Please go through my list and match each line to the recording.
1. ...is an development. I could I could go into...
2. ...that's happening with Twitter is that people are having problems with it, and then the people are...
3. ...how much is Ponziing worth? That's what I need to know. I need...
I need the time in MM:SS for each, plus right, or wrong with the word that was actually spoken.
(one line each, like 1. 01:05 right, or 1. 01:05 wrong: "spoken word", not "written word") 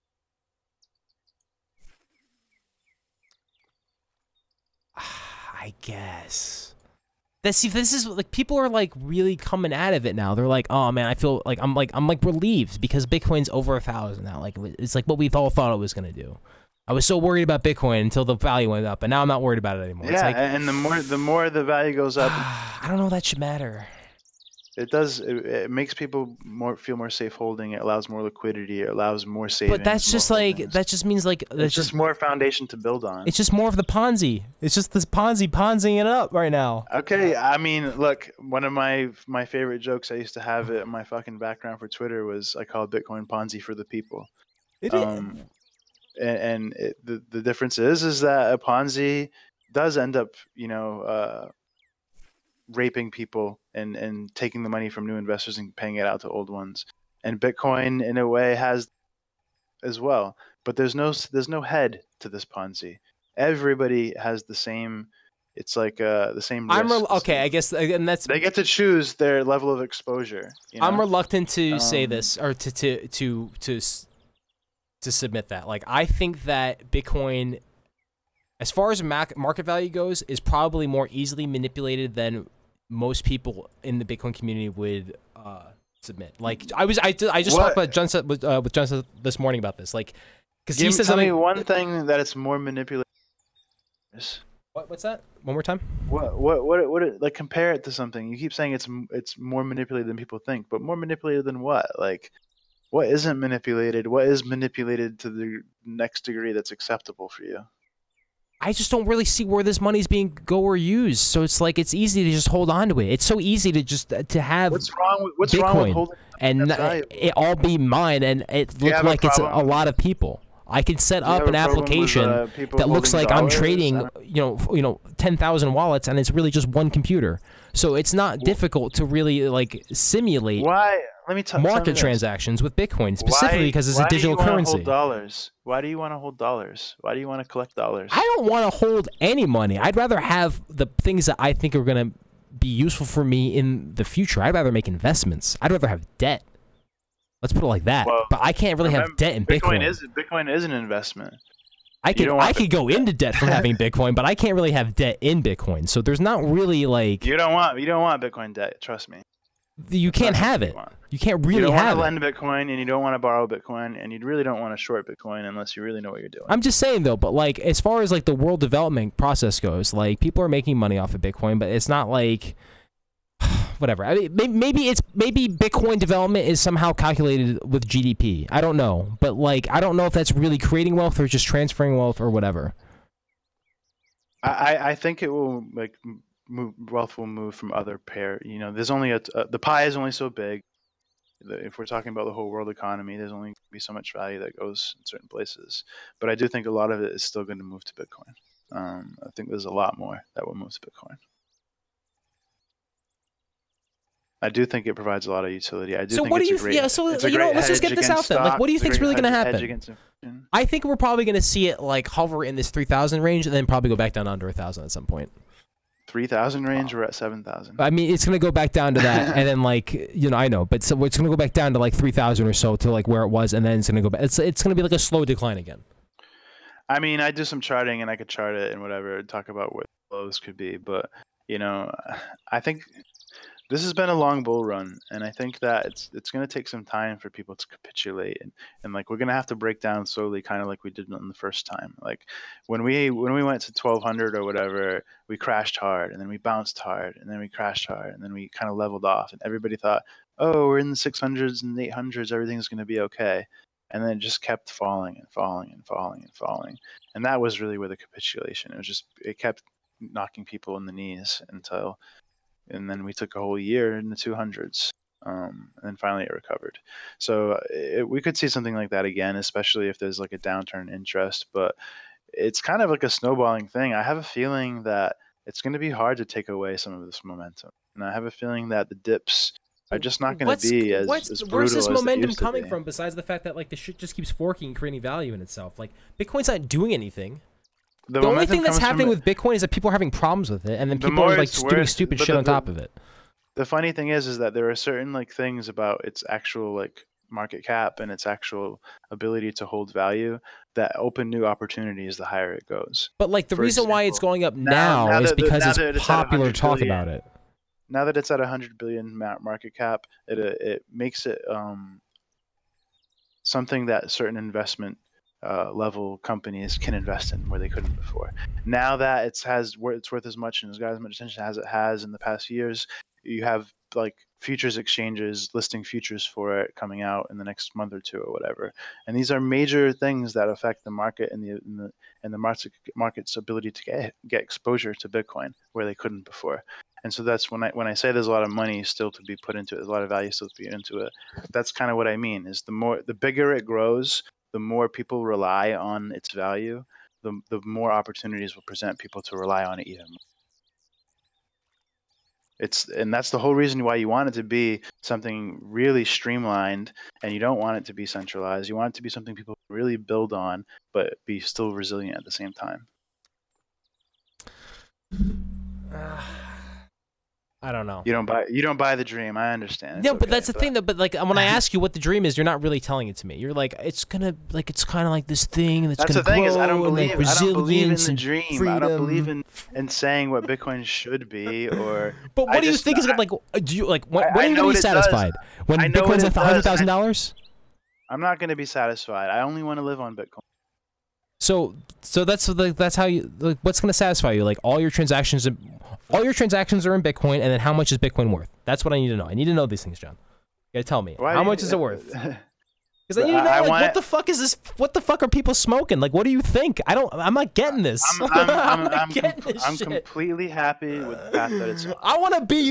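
1. 02:30 wrong: "investment", not "development"
2. 04:48 wrong: "Bitcoin", not "Twitter"
3. 06:37 wrong: "Bitcoin", not "Ponziing".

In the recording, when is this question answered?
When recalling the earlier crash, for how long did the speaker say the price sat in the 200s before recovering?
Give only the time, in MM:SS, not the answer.
04:23.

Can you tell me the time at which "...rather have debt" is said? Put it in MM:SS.
02:25.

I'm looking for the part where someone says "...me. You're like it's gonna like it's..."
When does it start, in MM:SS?
06:13.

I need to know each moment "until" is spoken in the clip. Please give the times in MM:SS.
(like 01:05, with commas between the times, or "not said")
00:18, 04:21.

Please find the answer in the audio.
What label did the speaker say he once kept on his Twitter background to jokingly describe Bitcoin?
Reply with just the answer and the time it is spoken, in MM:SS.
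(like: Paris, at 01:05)
Ponzi for the people, at 00:43.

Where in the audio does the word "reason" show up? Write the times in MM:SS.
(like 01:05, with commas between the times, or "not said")
05:03, 05:53.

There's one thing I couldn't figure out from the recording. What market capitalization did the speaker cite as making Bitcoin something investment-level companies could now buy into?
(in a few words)
100 billion.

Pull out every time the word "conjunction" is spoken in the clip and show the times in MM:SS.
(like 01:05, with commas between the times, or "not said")
not said.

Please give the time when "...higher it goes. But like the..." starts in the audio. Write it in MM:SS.
05:02.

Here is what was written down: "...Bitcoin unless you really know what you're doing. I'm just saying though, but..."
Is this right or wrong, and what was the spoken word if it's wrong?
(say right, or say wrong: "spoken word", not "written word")
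right.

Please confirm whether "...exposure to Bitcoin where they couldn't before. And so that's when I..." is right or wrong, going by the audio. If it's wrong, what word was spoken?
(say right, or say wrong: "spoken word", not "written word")
right.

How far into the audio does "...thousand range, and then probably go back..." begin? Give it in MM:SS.
03:32.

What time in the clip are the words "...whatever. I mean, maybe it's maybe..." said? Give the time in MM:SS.
02:53.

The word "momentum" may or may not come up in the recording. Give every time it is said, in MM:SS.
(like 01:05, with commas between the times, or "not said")
04:37, 04:41.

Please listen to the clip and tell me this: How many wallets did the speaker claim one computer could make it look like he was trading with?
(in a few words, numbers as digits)
10,000.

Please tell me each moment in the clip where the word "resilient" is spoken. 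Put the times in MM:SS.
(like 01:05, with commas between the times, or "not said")
06:01.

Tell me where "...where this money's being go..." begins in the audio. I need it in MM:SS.
01:49.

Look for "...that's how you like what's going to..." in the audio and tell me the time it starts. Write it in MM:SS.
06:32.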